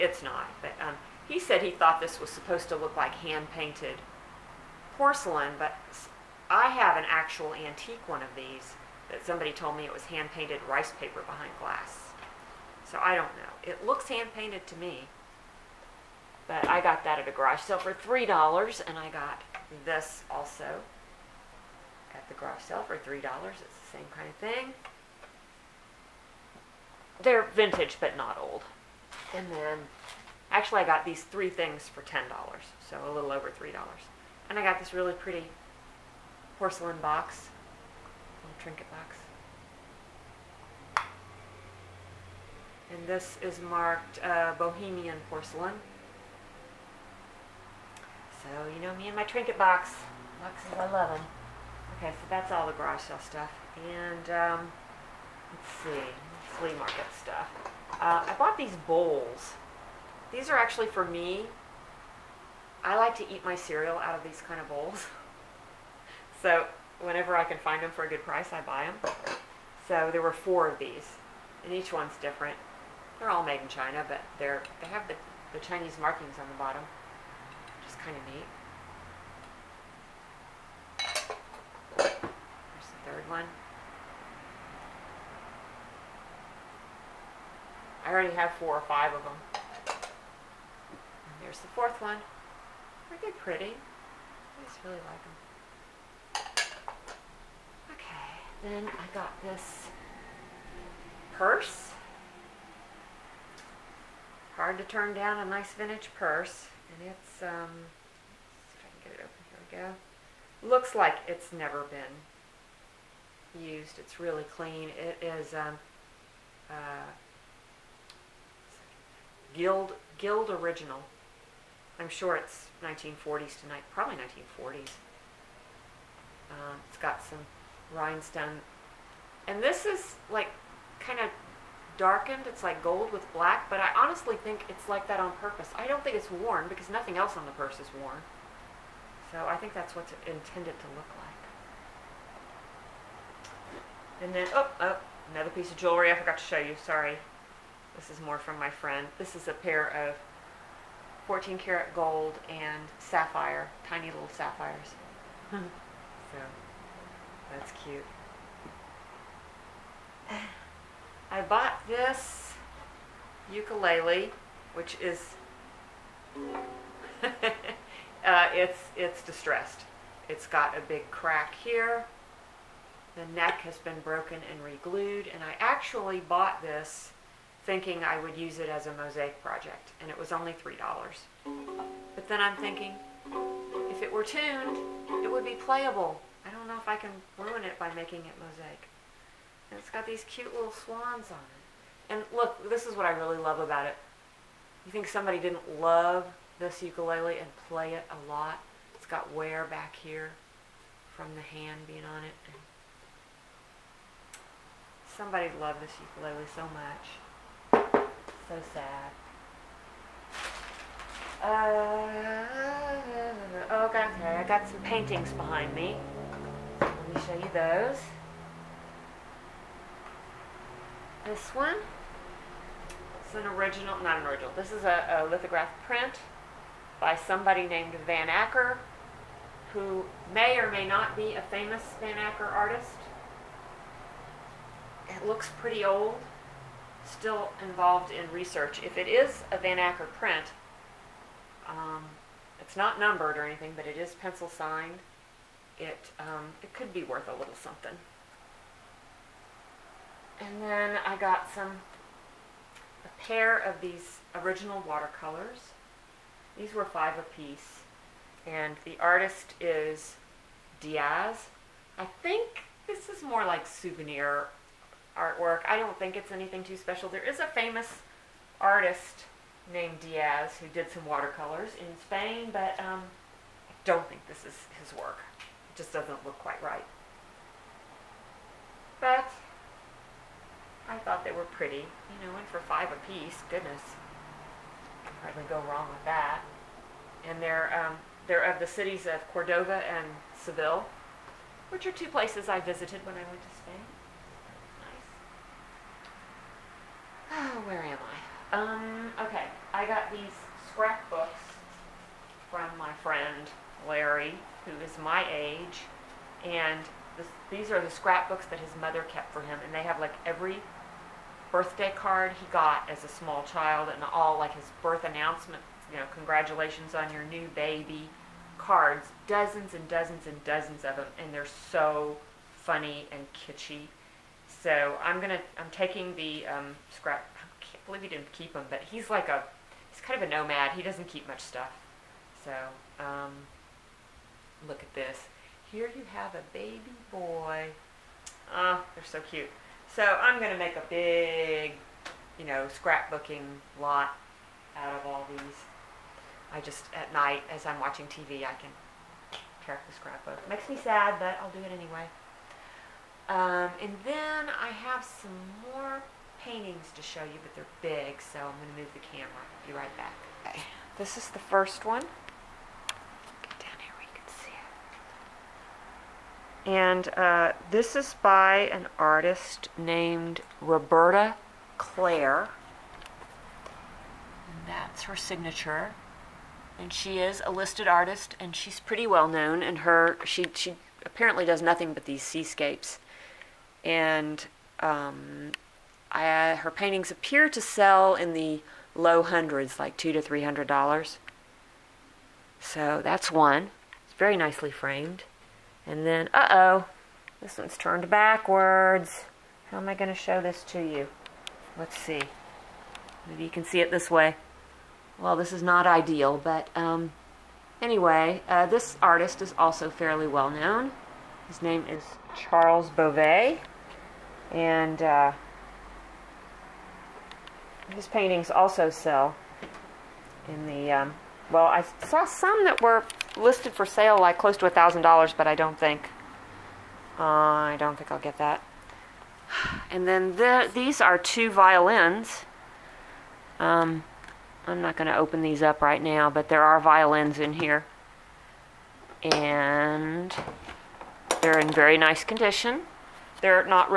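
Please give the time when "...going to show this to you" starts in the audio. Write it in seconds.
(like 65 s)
399 s.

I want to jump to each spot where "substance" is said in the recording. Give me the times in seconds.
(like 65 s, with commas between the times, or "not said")
not said.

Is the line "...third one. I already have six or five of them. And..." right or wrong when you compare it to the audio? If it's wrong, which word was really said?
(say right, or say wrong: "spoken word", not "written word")
wrong: "four", not "six".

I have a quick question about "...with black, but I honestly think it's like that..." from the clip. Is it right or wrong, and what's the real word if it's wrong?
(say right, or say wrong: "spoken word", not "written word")
right.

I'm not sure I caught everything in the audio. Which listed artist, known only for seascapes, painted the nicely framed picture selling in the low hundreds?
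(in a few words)
Roberta Clare.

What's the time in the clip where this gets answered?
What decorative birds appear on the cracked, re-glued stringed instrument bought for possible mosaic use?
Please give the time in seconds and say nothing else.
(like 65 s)
190 s.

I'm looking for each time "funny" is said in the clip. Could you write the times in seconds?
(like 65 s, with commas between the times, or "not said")
322 s.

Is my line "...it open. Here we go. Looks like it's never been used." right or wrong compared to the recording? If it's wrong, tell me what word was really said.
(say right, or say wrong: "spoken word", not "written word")
right.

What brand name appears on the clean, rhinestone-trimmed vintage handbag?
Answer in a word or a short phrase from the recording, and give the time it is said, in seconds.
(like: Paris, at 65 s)
Guild original, at 119 s.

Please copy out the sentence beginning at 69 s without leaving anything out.
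So there were four of these, and each one's different.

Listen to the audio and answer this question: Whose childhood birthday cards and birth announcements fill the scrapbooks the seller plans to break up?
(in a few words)
Larry.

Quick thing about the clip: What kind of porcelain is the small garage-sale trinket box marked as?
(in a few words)
Bohemian.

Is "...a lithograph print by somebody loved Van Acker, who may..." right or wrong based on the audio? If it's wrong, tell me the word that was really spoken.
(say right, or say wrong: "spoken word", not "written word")
wrong: "named", not "loved".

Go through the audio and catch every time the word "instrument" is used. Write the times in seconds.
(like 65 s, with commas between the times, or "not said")
not said.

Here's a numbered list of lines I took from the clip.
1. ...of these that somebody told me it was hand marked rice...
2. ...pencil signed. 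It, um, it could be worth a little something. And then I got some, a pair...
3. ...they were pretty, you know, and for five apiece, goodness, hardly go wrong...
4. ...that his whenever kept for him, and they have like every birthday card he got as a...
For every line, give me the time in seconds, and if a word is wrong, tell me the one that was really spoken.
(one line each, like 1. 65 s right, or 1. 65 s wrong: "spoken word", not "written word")
1. 8 s wrong: "painted", not "marked"
2. 244 s right
3. 281 s right
4. 308 s wrong: "mother", not "whenever".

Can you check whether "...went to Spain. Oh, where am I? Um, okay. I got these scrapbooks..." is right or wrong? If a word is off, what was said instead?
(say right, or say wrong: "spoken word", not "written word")
right.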